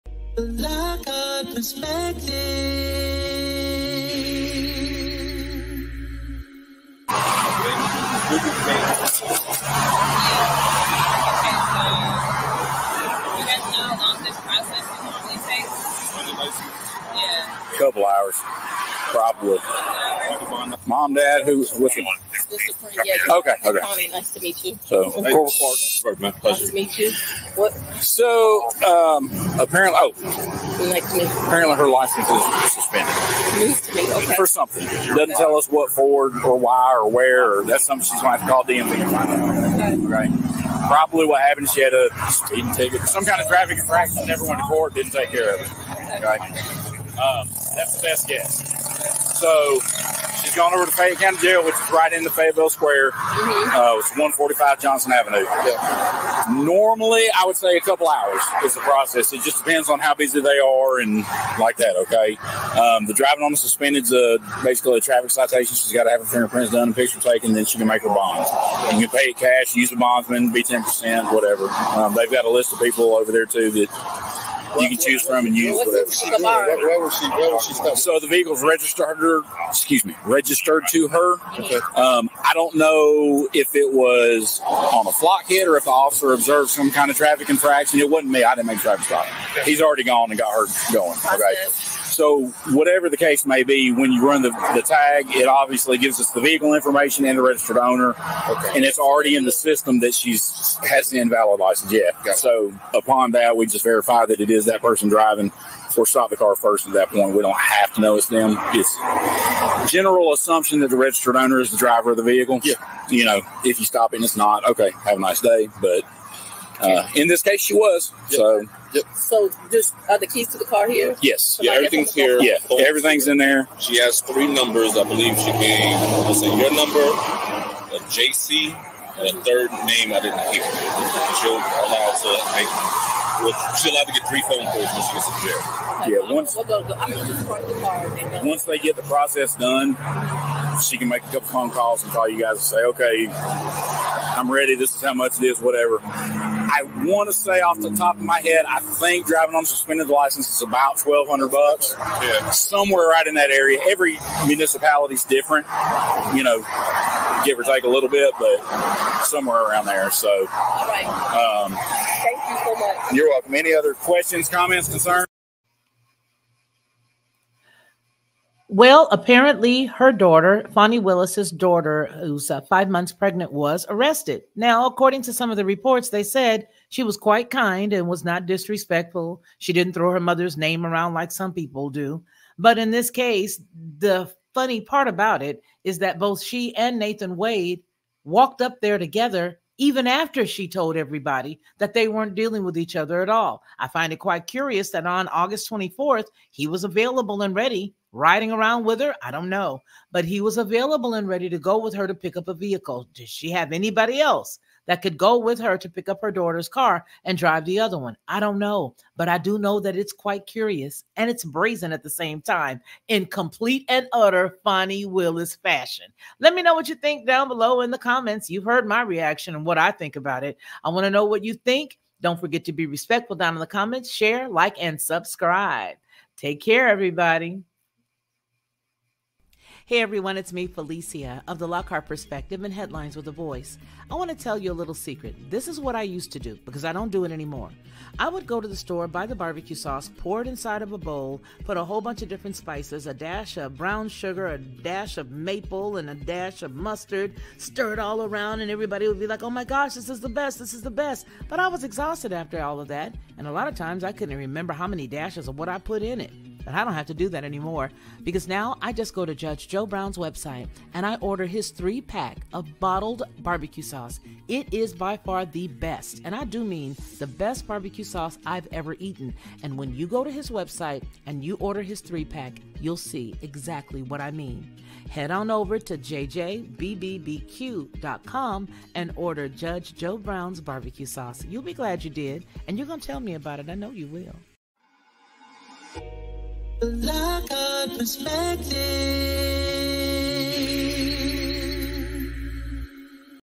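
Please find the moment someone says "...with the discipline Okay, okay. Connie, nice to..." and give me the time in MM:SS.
00:21.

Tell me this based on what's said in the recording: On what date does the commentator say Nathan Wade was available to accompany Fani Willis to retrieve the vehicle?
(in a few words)
August 24th.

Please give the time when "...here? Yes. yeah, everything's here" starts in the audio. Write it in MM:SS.
02:00.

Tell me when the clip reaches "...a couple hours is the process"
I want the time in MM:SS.
00:57.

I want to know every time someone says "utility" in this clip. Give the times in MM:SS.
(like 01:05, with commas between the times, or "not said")
not said.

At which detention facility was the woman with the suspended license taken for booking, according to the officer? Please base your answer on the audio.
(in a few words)
Fayette County Jail.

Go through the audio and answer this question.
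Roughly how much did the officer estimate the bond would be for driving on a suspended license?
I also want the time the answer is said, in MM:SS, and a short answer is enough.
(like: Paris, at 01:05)
$1,200, at 02:30.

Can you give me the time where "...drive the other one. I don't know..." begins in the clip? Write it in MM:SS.
03:27.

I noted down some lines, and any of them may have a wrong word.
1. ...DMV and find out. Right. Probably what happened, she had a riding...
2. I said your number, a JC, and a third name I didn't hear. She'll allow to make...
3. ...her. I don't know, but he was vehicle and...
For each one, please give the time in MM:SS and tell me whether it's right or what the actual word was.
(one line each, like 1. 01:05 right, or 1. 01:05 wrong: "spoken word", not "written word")
1. 00:38 wrong: "speeding", not "riding"
2. 02:05 right
3. 03:18 wrong: "available", not "vehicle".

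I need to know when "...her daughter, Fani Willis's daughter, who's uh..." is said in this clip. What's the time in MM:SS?
02:49.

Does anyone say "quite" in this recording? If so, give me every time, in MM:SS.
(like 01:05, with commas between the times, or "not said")
02:57, 03:14, 03:30.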